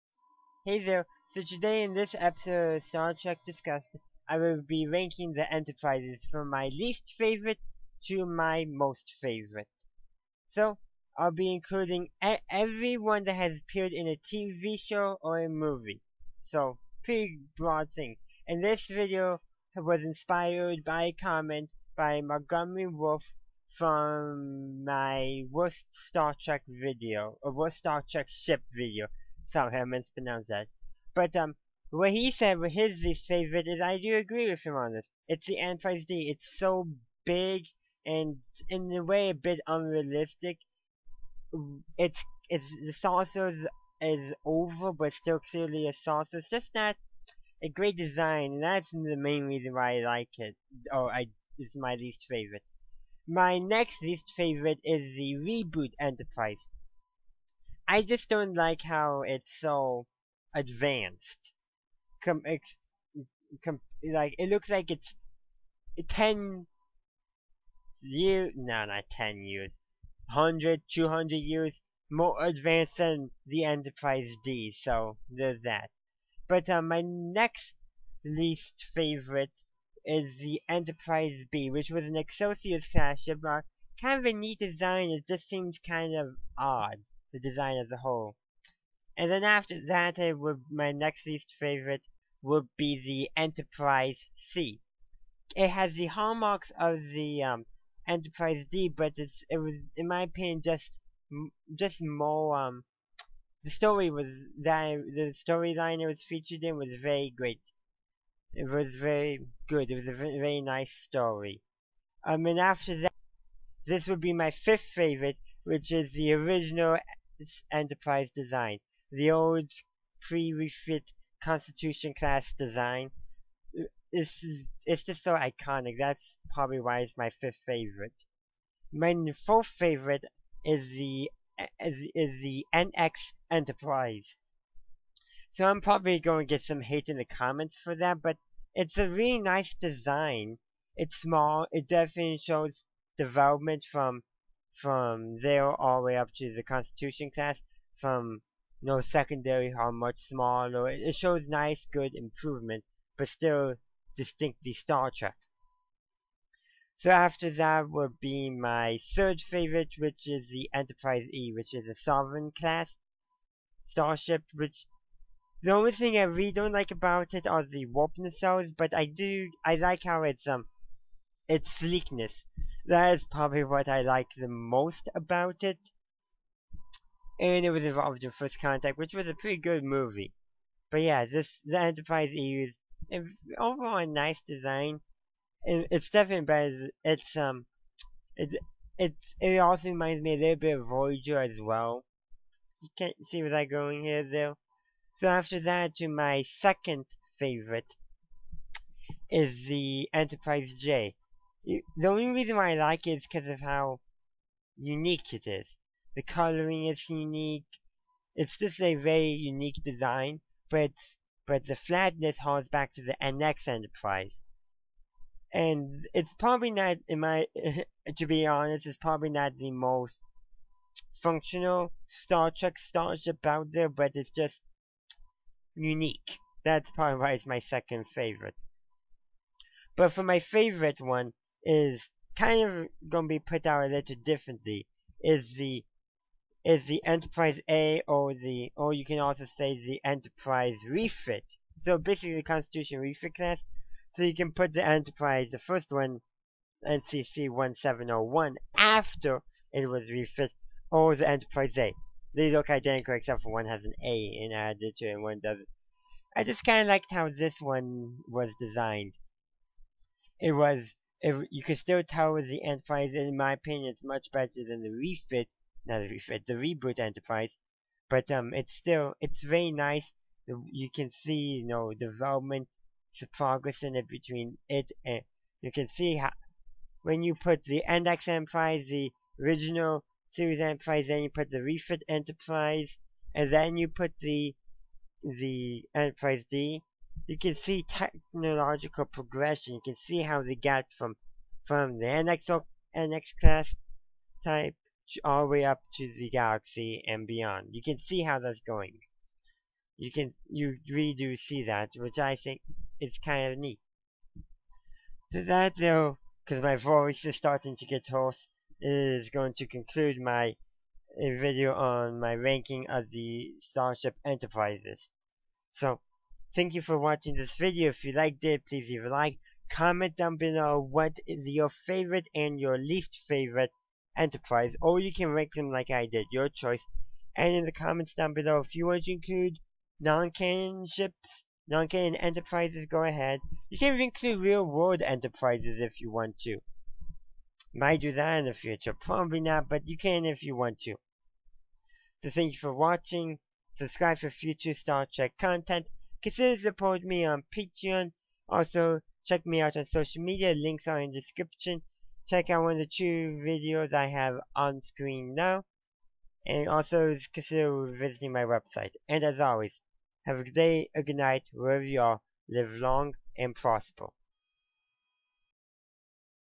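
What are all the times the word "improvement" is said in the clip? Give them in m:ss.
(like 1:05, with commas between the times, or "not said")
2:32.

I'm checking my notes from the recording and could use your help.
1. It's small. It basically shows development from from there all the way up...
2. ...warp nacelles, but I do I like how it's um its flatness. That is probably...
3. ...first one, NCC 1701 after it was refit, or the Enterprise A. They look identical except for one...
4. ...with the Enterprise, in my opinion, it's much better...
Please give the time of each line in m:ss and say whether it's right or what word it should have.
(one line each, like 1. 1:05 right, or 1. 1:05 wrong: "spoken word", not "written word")
1. 2:20 wrong: "definitely", not "basically"
2. 2:47 wrong: "sleekness", not "flatness"
3. 4:05 right
4. 4:22 right.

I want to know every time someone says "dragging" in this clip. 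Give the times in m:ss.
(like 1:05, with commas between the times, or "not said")
not said.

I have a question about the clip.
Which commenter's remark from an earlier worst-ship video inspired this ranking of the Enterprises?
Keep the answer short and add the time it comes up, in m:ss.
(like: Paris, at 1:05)
Montgomery Wolf, at 0:22.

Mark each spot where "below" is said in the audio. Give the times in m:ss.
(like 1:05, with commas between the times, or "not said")
5:20, 5:28.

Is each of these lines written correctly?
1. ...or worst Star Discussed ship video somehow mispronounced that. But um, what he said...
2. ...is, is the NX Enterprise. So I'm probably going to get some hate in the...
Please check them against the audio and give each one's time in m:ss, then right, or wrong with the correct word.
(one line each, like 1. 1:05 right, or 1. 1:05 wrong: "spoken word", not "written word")
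1. 0:27 wrong: "Trek", not "Discussed"
2. 2:11 right.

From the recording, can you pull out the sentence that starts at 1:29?
And then after that, it would, my next least favorite would be the Enterprise C.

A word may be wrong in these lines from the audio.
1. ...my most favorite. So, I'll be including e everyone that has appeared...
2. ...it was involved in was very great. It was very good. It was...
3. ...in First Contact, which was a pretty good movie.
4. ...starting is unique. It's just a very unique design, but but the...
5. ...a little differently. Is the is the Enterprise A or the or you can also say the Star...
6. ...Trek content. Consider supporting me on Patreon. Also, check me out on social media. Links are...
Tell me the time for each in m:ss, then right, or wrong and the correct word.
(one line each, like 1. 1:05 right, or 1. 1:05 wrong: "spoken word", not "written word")
1. 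0:08 right
2. 1:46 wrong: "featured", not "involved"
3. 2:58 right
4. 3:26 wrong: "coloring", not "starting"
5. 3:53 wrong: "Enterprise", not "Star"
6. 5:45 right.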